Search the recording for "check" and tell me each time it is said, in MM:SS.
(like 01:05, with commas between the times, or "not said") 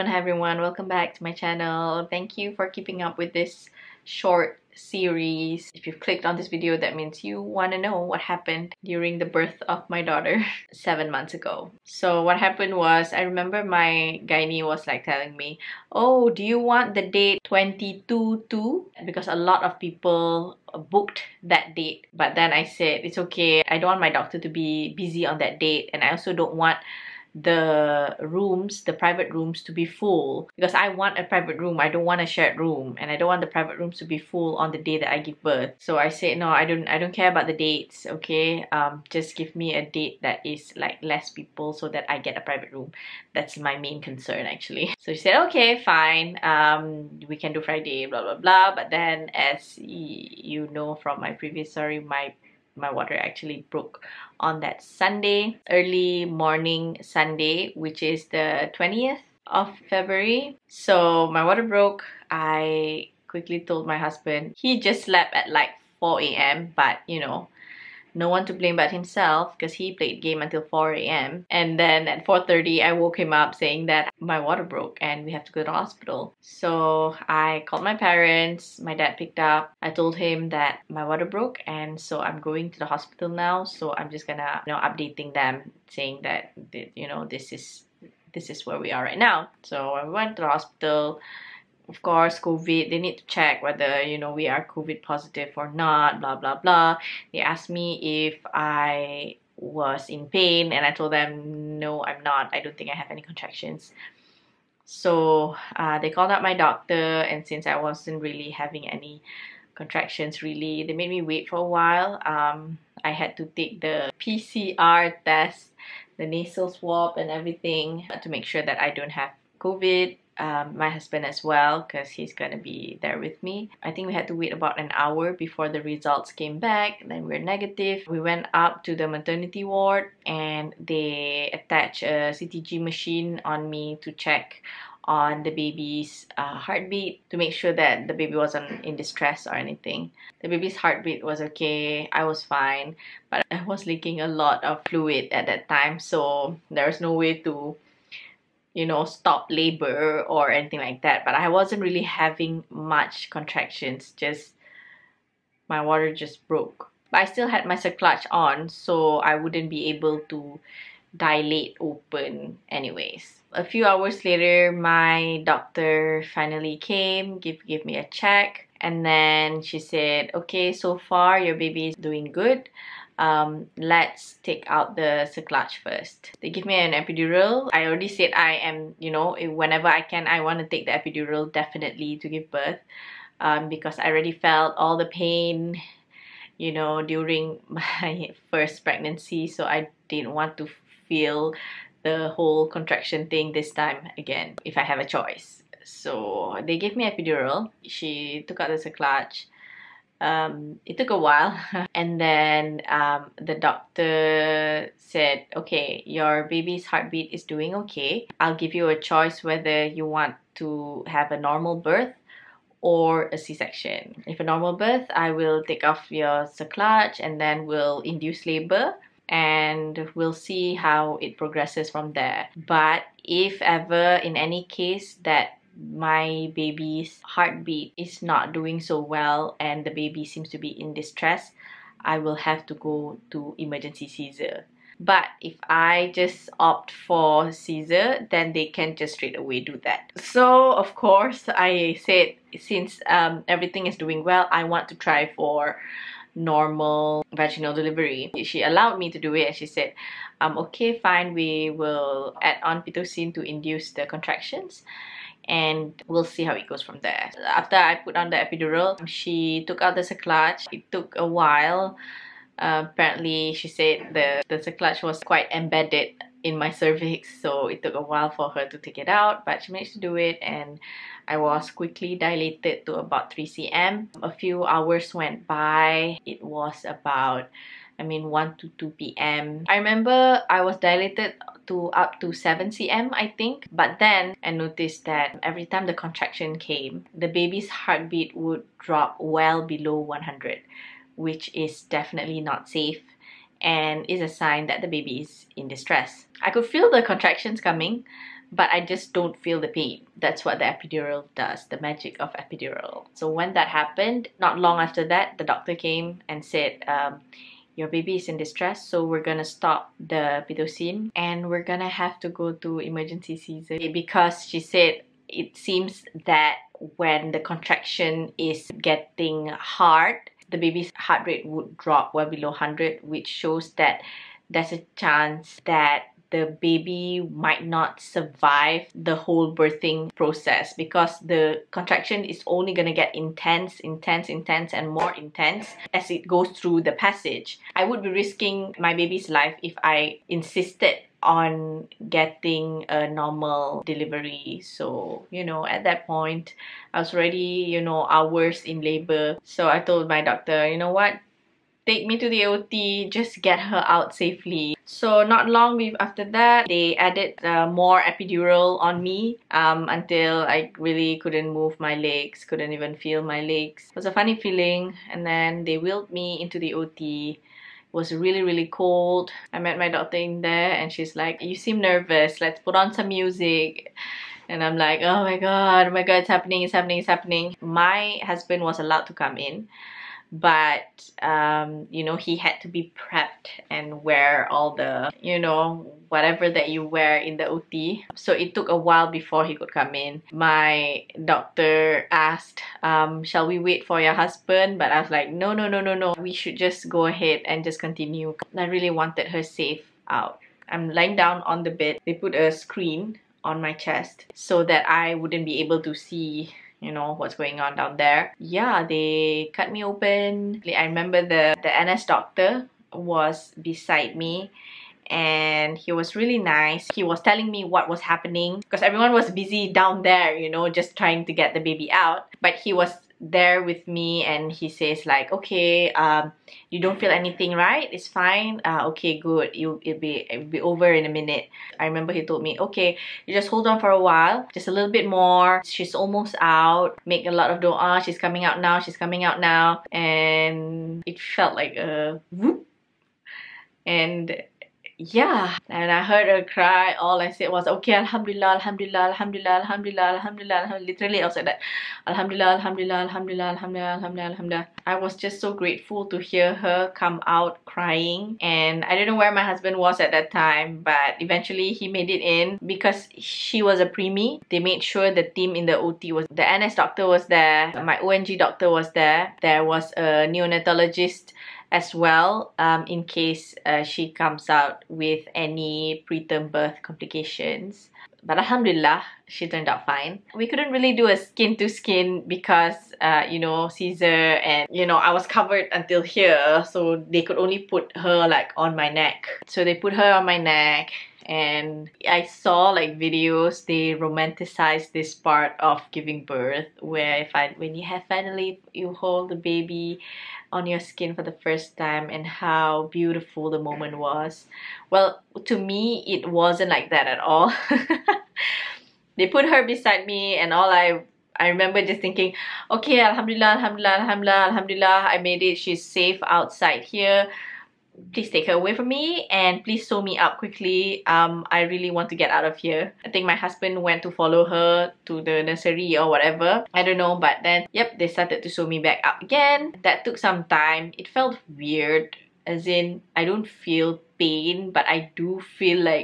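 01:33, 02:14, 02:48.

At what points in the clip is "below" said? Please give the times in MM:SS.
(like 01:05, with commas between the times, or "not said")
04:49, 05:22.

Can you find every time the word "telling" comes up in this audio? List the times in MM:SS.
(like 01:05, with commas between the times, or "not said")
00:15, 06:57.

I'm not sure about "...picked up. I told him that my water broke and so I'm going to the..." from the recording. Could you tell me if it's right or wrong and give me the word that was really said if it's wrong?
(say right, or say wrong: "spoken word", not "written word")
right.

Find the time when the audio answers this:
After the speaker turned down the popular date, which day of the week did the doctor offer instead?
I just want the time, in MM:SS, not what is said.
00:47.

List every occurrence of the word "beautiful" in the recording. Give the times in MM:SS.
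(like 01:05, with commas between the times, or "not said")
08:22.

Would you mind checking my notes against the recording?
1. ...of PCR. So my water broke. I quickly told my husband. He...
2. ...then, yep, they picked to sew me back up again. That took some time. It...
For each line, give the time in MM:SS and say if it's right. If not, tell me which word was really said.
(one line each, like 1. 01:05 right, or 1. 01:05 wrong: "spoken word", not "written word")
1. 00:59 wrong: "February", not "PCR"
2. 08:47 wrong: "started", not "picked".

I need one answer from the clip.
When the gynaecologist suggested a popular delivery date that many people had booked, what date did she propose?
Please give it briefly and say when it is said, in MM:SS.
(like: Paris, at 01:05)
22/2, at 00:17.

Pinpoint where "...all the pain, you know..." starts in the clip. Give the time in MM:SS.
03:04.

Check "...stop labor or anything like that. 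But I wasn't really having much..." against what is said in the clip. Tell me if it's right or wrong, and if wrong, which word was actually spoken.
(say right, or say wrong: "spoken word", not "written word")
right.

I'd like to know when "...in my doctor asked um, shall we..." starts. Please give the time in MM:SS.
06:29.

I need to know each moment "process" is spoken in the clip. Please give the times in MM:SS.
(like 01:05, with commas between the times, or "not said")
05:30.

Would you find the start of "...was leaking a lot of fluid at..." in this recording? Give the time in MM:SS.
02:23.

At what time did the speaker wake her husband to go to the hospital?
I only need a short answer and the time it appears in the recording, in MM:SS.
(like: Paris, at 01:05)
4:30, at 01:12.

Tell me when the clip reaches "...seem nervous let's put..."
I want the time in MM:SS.
06:11.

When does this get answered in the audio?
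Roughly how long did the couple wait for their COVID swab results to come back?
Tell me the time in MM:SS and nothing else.
02:04.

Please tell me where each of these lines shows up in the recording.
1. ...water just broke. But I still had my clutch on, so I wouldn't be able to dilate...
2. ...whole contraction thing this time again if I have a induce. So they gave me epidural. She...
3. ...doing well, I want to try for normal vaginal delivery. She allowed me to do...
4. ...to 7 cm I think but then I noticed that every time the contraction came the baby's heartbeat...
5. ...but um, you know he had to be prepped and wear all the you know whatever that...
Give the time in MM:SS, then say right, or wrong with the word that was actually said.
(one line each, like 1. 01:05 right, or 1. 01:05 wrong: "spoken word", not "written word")
1. 02:35 right
2. 03:12 wrong: "choice", not "induce"
3. 04:03 right
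4. 04:42 right
5. 06:20 right.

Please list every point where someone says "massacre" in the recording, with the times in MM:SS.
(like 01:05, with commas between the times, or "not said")
not said.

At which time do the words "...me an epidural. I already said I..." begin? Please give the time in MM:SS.
02:56.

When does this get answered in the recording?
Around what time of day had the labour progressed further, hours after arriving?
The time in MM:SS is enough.
04:38.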